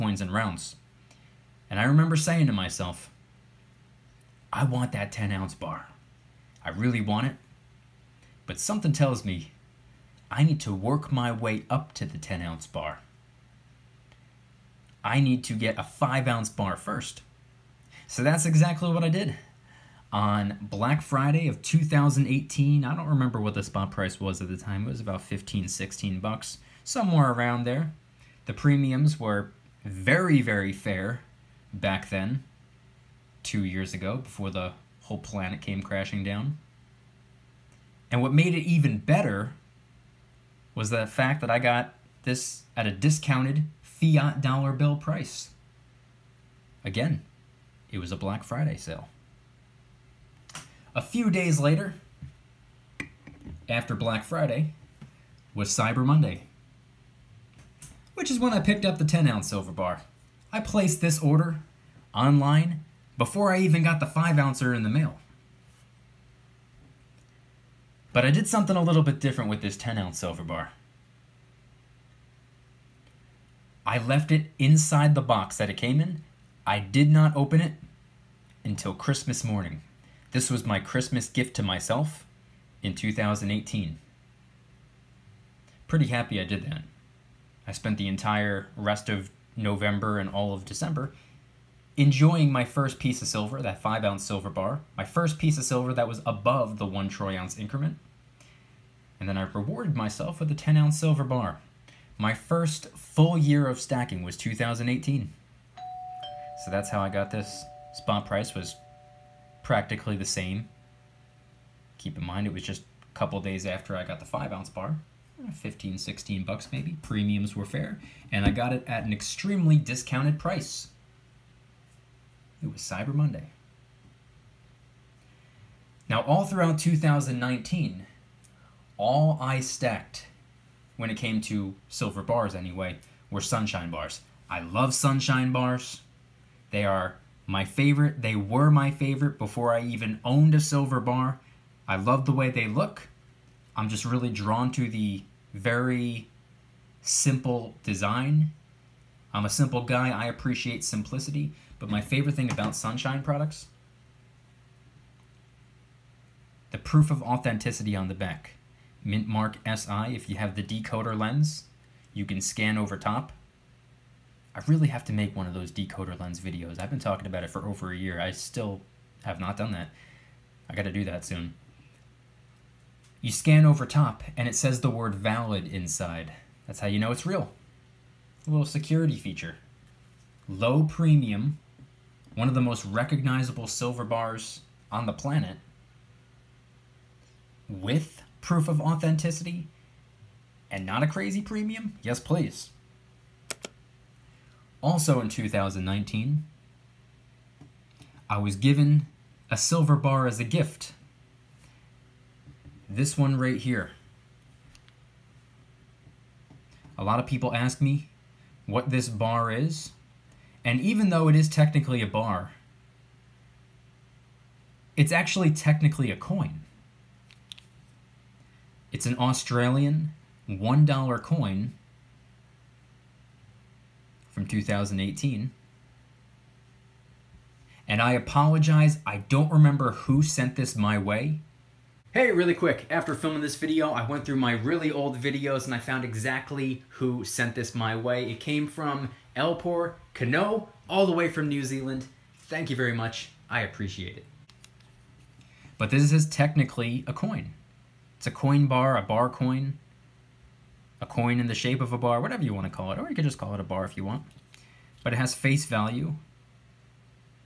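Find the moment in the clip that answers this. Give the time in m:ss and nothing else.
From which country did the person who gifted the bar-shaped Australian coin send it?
4:01.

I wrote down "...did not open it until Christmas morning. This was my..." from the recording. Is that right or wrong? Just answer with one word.
right.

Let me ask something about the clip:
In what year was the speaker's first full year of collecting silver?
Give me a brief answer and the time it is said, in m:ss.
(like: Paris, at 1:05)
2018, at 1:42.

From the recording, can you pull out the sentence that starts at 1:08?
But I did something a little bit different with this 10 ounce silver bar.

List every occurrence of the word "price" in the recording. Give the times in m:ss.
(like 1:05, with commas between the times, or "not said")
0:23, 0:44, 1:48, 2:00.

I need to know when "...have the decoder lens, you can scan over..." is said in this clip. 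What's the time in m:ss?
2:40.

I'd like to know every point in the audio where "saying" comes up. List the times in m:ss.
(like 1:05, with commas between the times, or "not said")
0:02.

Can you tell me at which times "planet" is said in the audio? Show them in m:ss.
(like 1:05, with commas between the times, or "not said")
0:35, 3:05.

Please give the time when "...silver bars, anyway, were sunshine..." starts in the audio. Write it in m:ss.
2:11.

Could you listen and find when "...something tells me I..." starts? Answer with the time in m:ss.
0:08.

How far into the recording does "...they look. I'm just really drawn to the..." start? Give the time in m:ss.
2:22.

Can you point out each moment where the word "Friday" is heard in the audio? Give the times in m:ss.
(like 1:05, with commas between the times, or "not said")
0:21, 0:48, 0:54.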